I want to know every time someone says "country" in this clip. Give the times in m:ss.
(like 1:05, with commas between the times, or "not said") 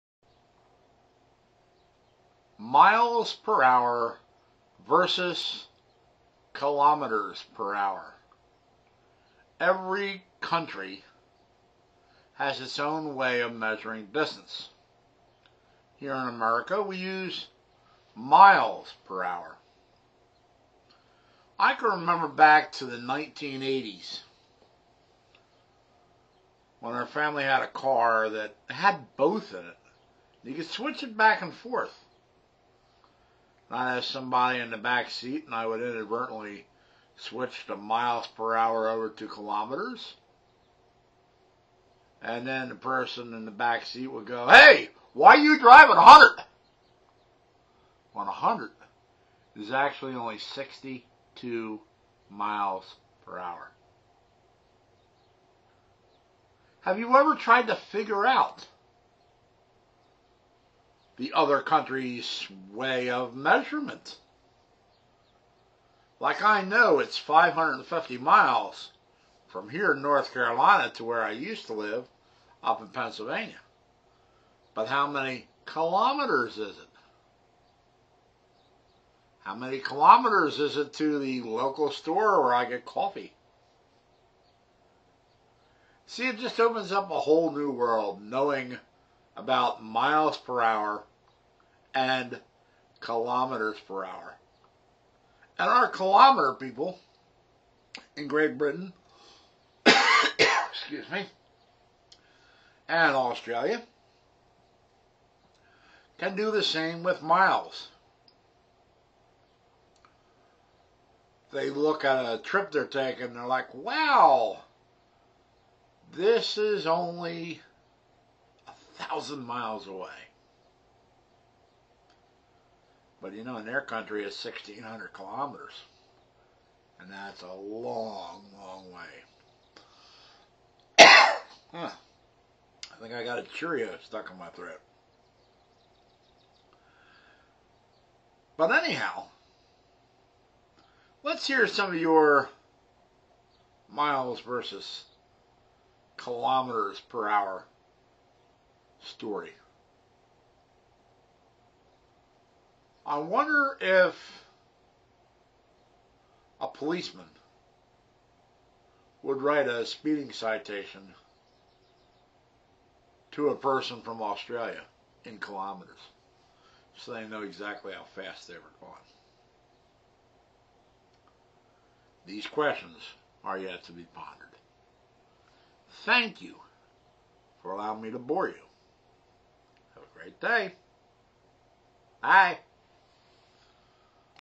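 0:10, 1:01, 2:03.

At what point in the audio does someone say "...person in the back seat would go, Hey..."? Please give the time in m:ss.
0:42.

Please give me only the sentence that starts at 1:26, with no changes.
See, it just opens up a whole new world knowing about miles per hour and kilometers per hour.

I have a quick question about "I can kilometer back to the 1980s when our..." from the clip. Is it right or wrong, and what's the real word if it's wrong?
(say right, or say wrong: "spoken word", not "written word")
wrong: "remember", not "kilometer".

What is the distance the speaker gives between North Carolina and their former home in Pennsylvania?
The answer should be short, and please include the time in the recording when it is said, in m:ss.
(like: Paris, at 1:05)
550 miles, at 1:07.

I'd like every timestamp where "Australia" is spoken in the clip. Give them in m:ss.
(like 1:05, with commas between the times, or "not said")
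1:43, 2:44.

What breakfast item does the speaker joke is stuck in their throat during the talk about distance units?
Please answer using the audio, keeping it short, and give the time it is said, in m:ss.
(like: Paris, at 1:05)
A Cheerio, at 2:13.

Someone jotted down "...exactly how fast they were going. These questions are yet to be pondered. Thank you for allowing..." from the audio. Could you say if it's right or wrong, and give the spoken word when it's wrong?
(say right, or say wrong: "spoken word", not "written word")
right.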